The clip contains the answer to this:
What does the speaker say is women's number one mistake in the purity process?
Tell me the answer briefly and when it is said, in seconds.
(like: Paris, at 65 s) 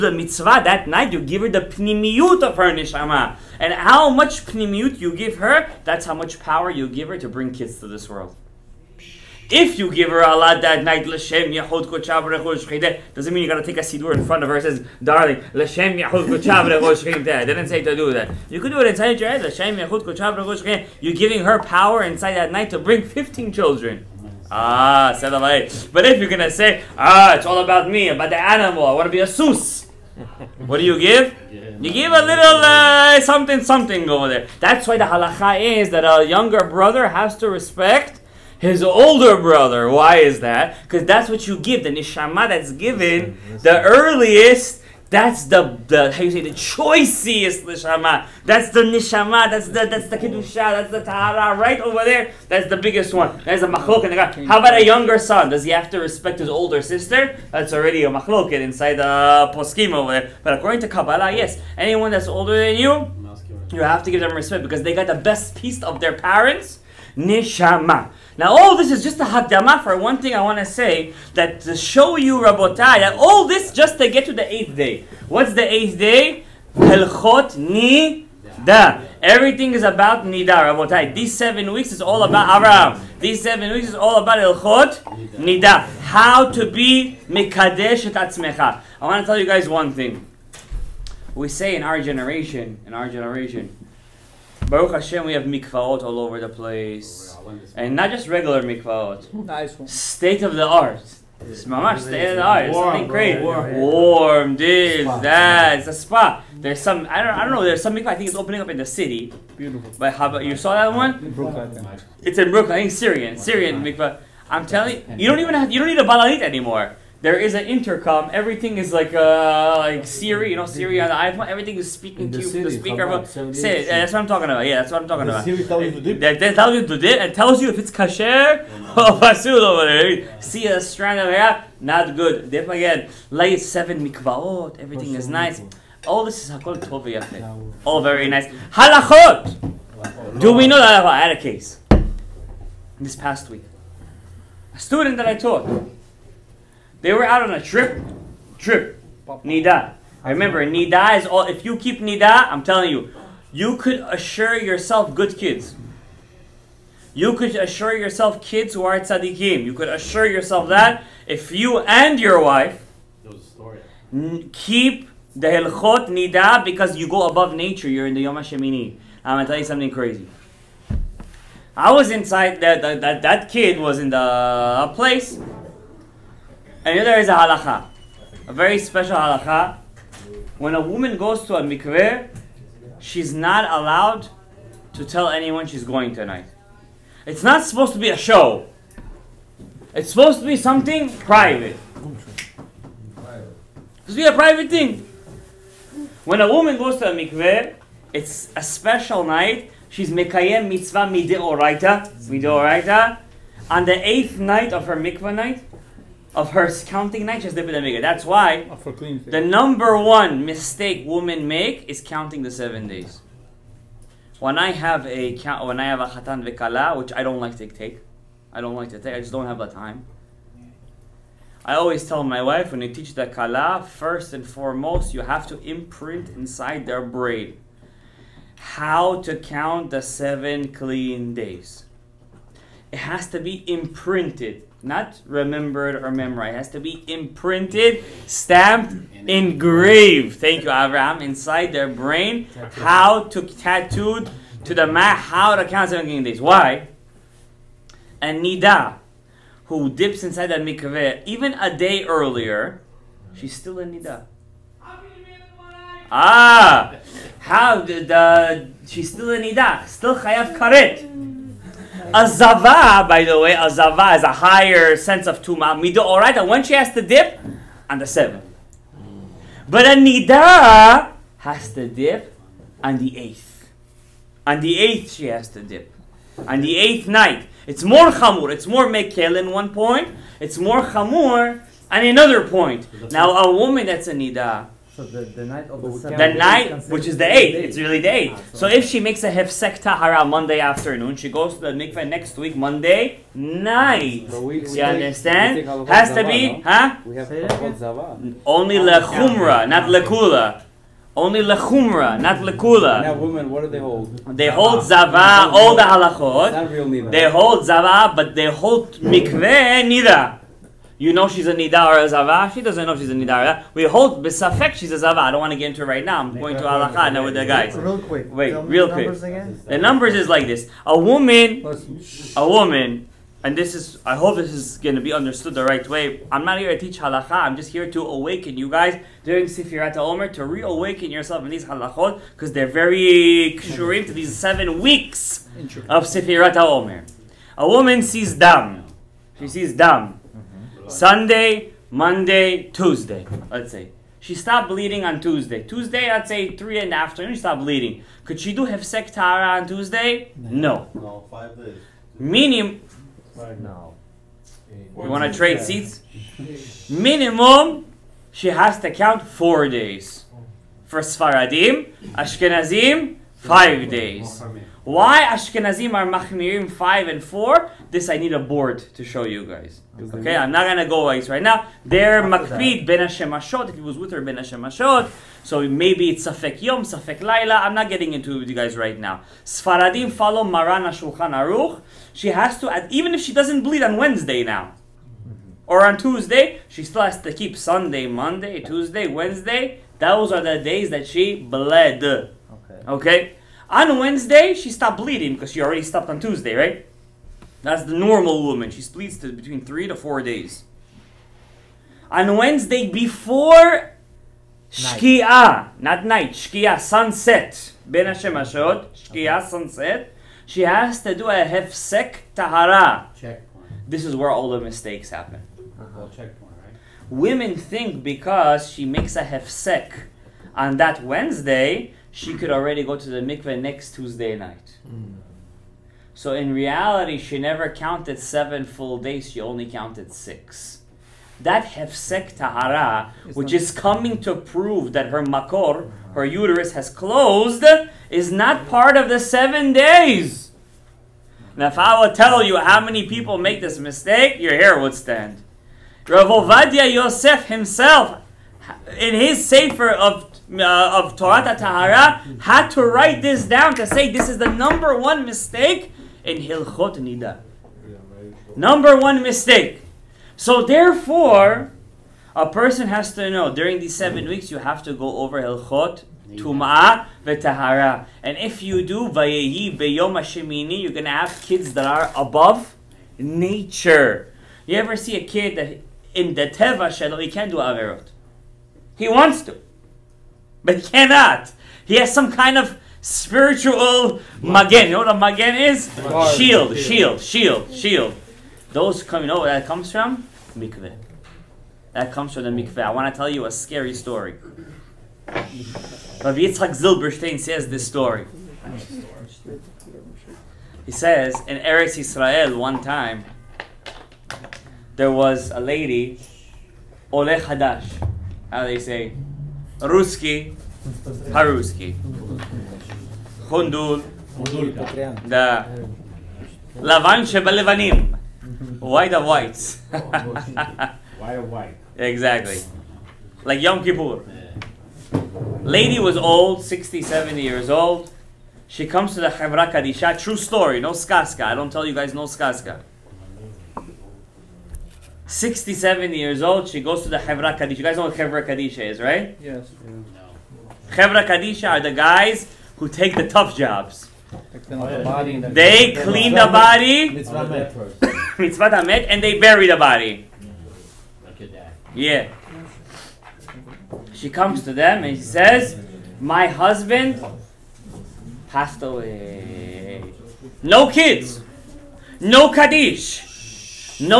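Counting the seven days, at 212 s.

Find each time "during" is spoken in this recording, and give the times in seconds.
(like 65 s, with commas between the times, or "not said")
329 s, 463 s.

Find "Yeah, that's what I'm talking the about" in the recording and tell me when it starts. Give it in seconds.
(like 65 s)
124 s.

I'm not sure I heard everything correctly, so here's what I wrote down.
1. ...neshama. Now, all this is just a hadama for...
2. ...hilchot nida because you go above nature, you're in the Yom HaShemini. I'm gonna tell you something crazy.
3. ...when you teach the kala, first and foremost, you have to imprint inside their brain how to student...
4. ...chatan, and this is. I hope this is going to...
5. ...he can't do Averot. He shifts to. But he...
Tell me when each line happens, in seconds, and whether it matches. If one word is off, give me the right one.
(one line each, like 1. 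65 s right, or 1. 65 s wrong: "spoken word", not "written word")
1. 67 s right
2. 165 s right
3. 222 s wrong: "count", not "student"
4. 322 s wrong: "woman", not "chatan"
5. 477 s wrong: "wants", not "shifts".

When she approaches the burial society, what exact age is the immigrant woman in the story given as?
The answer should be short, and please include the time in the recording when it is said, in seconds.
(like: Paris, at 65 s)
67, at 535 s.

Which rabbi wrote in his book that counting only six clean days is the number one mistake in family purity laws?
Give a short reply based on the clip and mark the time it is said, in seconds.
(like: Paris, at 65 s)
Rav Ovadia Yosef, at 446 s.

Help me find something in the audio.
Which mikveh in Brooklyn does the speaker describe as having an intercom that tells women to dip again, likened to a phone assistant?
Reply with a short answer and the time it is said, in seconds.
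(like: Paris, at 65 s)
Syrian mikvah, at 113 s.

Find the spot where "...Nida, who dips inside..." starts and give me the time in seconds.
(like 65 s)
248 s.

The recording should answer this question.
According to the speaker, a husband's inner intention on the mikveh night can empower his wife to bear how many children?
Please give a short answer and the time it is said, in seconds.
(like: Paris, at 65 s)
15, at 23 s.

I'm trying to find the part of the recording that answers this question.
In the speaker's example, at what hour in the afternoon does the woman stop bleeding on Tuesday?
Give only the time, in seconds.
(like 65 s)
346 s.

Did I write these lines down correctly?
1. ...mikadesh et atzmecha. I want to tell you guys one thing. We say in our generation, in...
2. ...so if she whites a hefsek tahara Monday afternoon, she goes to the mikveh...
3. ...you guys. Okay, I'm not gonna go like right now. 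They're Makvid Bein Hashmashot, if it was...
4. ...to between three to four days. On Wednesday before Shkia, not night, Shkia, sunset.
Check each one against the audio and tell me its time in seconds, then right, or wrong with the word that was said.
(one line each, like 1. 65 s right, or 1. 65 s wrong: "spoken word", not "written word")
1. 87 s right
2. 288 s wrong: "makes", not "whites"
3. 369 s right
4. 399 s right.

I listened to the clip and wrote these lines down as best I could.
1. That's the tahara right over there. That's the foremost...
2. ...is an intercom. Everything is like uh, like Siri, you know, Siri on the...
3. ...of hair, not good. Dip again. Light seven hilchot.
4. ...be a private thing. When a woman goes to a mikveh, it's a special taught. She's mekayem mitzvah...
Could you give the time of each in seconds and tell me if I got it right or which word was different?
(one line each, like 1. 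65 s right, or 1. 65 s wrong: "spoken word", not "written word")
1. 50 s wrong: "biggest", not "foremost"
2. 117 s right
3. 131 s wrong: "mikvaot", not "hilchot"
4. 194 s wrong: "night", not "taught".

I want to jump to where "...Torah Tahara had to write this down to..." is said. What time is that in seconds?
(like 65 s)
451 s.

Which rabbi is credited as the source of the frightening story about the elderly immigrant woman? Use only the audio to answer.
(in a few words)
Rabbi Yitzhak Zilberstein.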